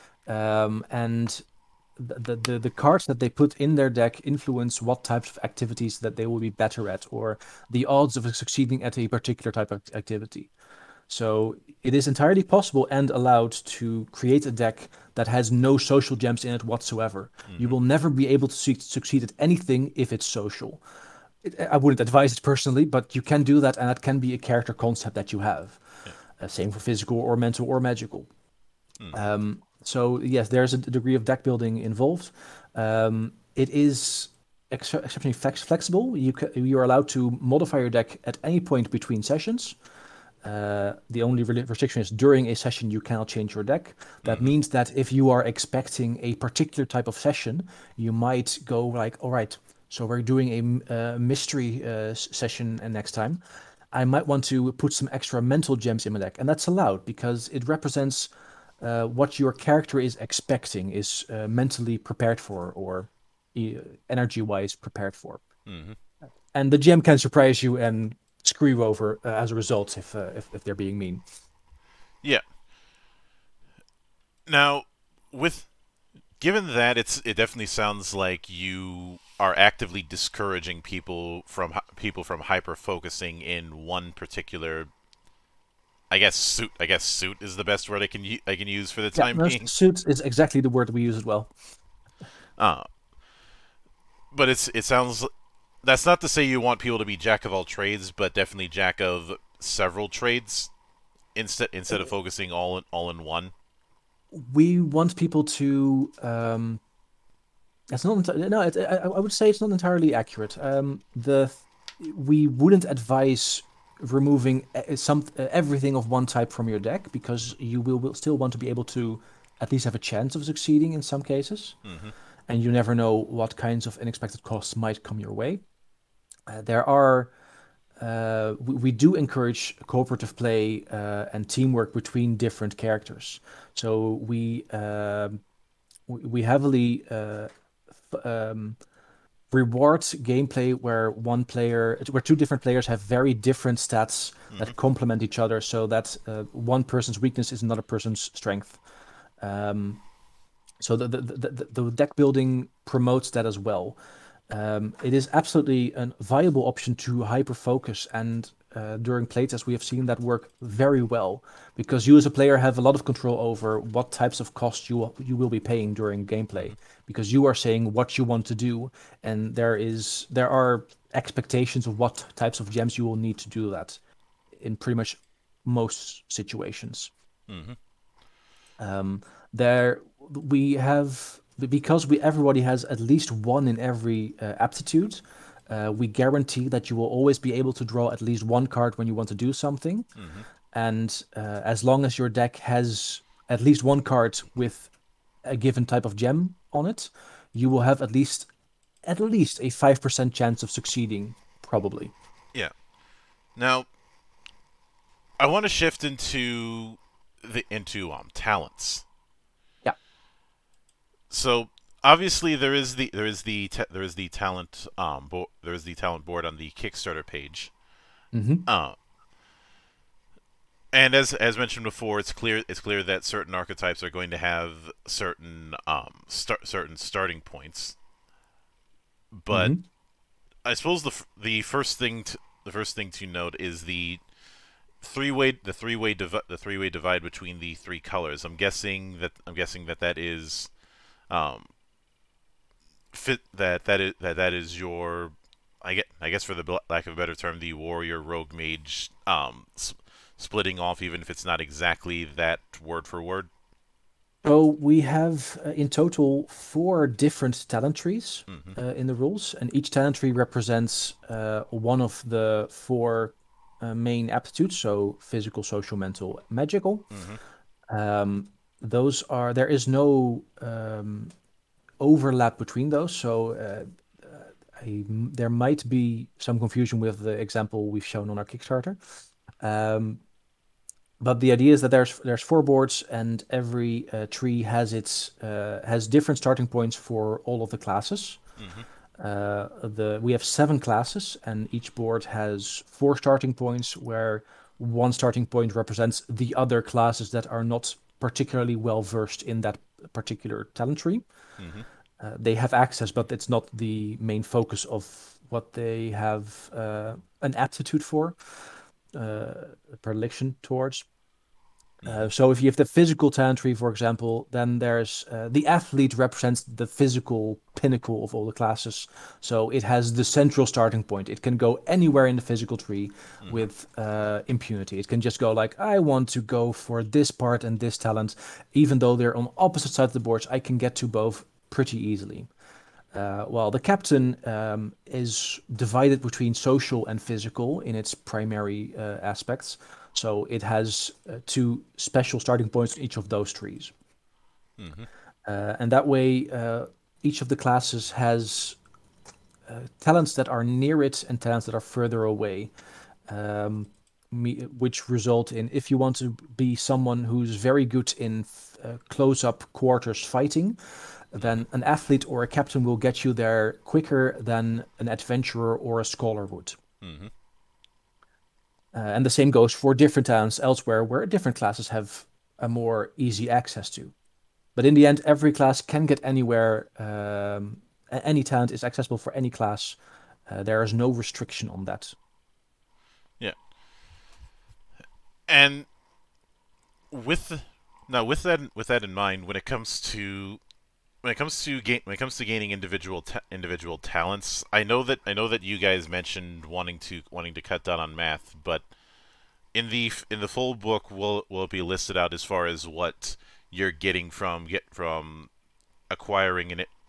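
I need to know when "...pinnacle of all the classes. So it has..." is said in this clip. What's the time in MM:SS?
05:17.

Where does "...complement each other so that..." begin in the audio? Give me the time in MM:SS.
02:24.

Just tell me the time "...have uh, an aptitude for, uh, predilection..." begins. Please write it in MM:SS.
05:06.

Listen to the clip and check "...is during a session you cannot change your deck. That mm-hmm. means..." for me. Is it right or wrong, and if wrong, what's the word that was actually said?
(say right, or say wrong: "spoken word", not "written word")
right.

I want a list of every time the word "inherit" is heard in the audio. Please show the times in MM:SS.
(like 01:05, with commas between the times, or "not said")
not said.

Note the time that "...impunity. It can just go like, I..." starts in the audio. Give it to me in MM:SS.
05:24.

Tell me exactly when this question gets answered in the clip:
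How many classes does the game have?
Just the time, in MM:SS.
04:50.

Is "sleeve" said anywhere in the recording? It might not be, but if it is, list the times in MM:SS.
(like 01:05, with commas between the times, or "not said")
not said.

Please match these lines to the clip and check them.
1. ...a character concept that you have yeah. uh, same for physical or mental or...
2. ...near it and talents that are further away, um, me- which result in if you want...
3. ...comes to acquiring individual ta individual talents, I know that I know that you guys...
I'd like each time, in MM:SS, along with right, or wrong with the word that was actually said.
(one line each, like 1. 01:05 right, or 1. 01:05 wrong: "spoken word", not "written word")
1. 00:24 right
2. 05:50 right
3. 06:32 wrong: "gaining", not "acquiring".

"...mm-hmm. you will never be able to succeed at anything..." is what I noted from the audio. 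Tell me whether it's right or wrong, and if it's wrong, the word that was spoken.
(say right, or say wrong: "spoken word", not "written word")
right.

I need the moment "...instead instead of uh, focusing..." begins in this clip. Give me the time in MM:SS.
01:41.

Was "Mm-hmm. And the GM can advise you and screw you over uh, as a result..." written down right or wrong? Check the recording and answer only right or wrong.
wrong.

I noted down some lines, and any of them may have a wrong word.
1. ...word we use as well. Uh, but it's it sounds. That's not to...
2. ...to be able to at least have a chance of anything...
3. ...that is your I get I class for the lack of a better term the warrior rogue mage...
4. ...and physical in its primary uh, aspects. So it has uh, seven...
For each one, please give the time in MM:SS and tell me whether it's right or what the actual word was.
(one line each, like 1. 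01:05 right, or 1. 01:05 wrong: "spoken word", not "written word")
1. 01:30 right
2. 01:58 wrong: "succeeding", not "anything"
3. 04:04 wrong: "guess", not "class"
4. 05:37 wrong: "two", not "seven".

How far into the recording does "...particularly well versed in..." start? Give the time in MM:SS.
04:58.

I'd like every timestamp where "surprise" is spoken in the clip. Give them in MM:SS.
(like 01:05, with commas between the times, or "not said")
01:07.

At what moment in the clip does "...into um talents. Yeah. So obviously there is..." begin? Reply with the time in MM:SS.
03:27.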